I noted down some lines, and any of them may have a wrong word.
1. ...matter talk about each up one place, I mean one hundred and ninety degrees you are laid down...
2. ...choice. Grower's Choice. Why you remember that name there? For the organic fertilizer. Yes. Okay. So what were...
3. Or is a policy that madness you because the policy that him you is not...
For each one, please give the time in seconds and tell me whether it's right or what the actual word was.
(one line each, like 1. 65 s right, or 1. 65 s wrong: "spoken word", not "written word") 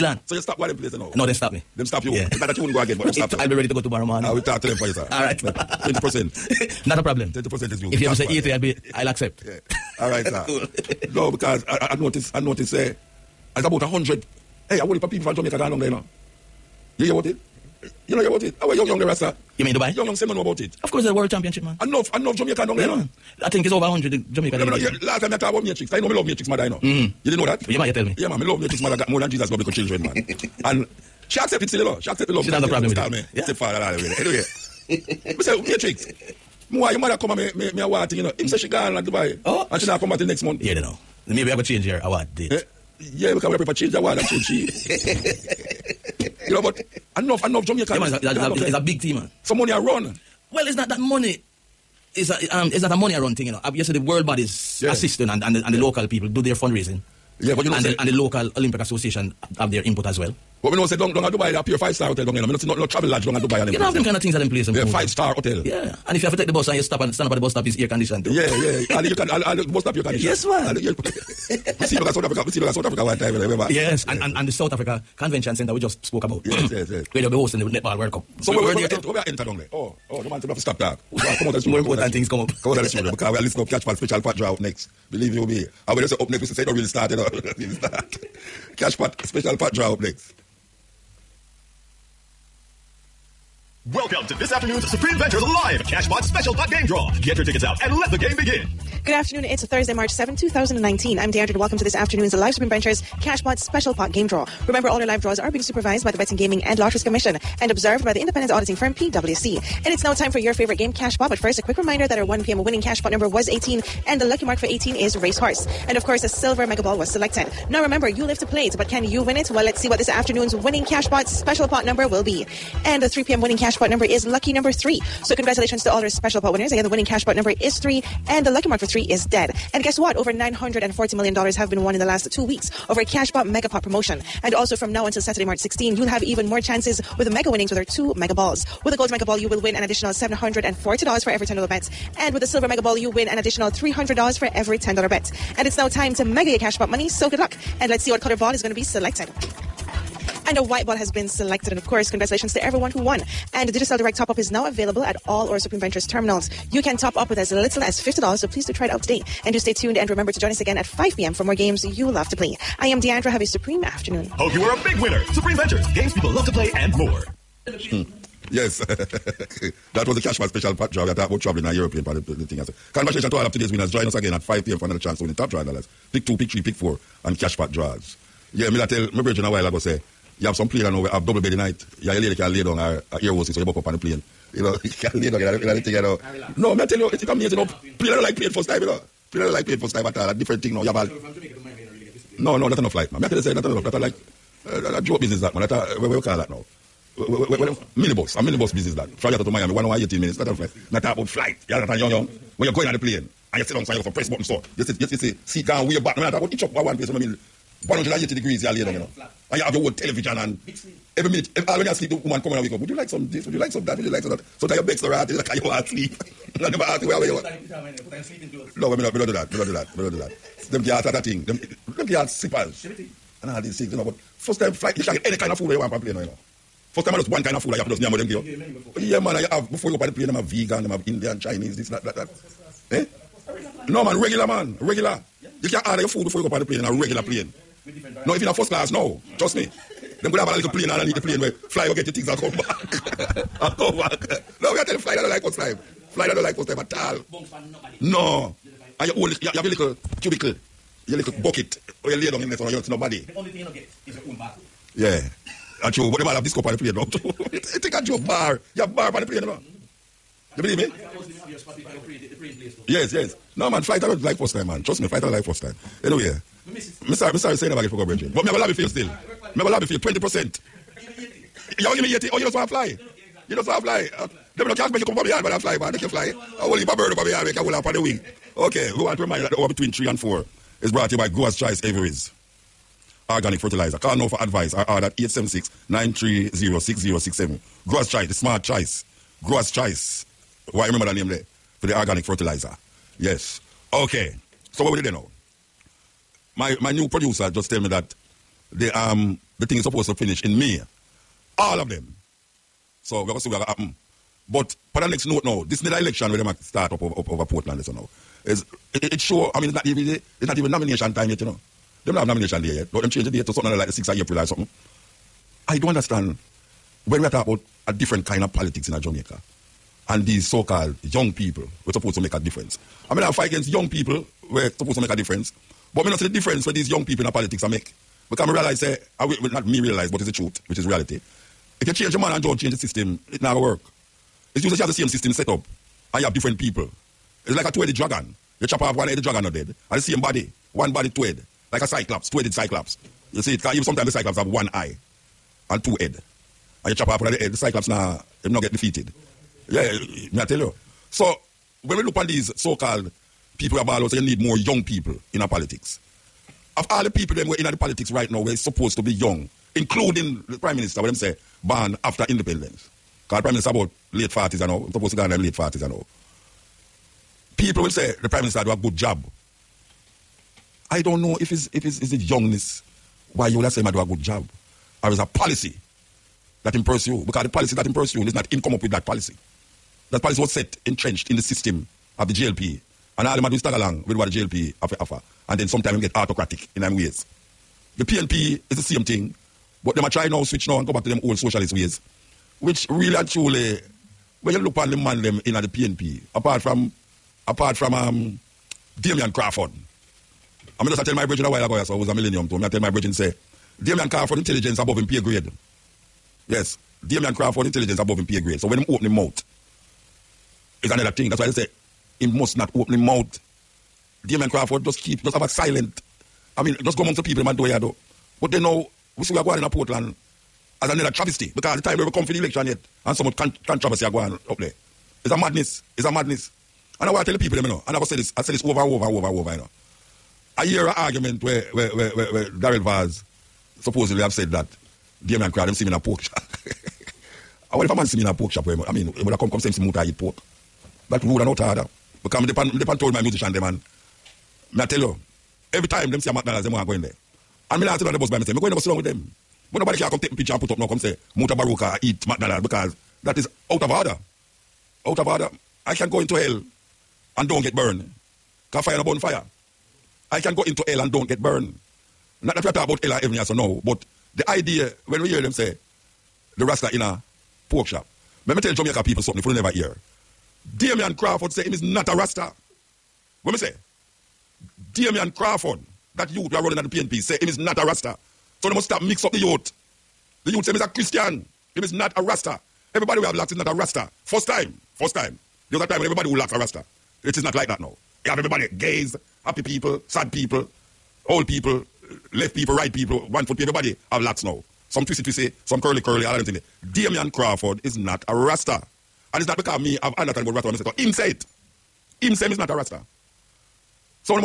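1. 206 s wrong: "eighty", not "ninety"
2. 288 s right
3. 375 s wrong: "impress", not "madness".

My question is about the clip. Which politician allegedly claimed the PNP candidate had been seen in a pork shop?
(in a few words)
Daryl Vaz.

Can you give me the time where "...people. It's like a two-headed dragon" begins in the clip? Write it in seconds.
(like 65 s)
336 s.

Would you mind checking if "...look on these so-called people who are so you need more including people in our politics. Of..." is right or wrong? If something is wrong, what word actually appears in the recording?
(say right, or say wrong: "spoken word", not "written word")
wrong: "young", not "including".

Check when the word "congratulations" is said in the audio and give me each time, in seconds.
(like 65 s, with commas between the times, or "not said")
125 s, 152 s, 172 s.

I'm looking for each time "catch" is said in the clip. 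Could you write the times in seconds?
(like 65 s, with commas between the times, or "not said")
83 s.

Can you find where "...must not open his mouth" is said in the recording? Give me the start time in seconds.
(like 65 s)
412 s.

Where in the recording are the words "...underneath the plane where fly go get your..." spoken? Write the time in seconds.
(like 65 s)
240 s.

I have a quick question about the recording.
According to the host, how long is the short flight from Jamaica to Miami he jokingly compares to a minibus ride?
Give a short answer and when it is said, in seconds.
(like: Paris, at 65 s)
1 hour 18 minutes, at 199 s.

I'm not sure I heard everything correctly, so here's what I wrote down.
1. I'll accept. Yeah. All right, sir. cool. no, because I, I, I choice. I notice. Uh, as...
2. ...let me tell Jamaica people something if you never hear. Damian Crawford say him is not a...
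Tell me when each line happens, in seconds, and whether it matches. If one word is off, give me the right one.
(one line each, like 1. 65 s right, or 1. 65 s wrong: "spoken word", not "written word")
1. 8 s wrong: "notice", not "choice"
2. 468 s right.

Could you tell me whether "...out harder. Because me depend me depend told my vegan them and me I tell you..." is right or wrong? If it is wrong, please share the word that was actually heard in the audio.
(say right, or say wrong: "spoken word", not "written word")
wrong: "musician", not "vegan".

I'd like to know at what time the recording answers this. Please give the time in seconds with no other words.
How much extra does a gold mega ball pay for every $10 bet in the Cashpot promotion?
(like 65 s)
140 s.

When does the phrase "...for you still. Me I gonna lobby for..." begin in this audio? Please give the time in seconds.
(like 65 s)
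268 s.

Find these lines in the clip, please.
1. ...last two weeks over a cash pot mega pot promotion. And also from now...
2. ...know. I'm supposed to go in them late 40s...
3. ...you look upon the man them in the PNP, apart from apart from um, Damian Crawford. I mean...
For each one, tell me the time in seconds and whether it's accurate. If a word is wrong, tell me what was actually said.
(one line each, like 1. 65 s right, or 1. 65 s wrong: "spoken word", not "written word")
1. 132 s right
2. 364 s right
3. 394 s right.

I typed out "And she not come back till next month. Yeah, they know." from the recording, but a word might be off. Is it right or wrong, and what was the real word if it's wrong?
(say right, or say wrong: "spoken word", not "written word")
right.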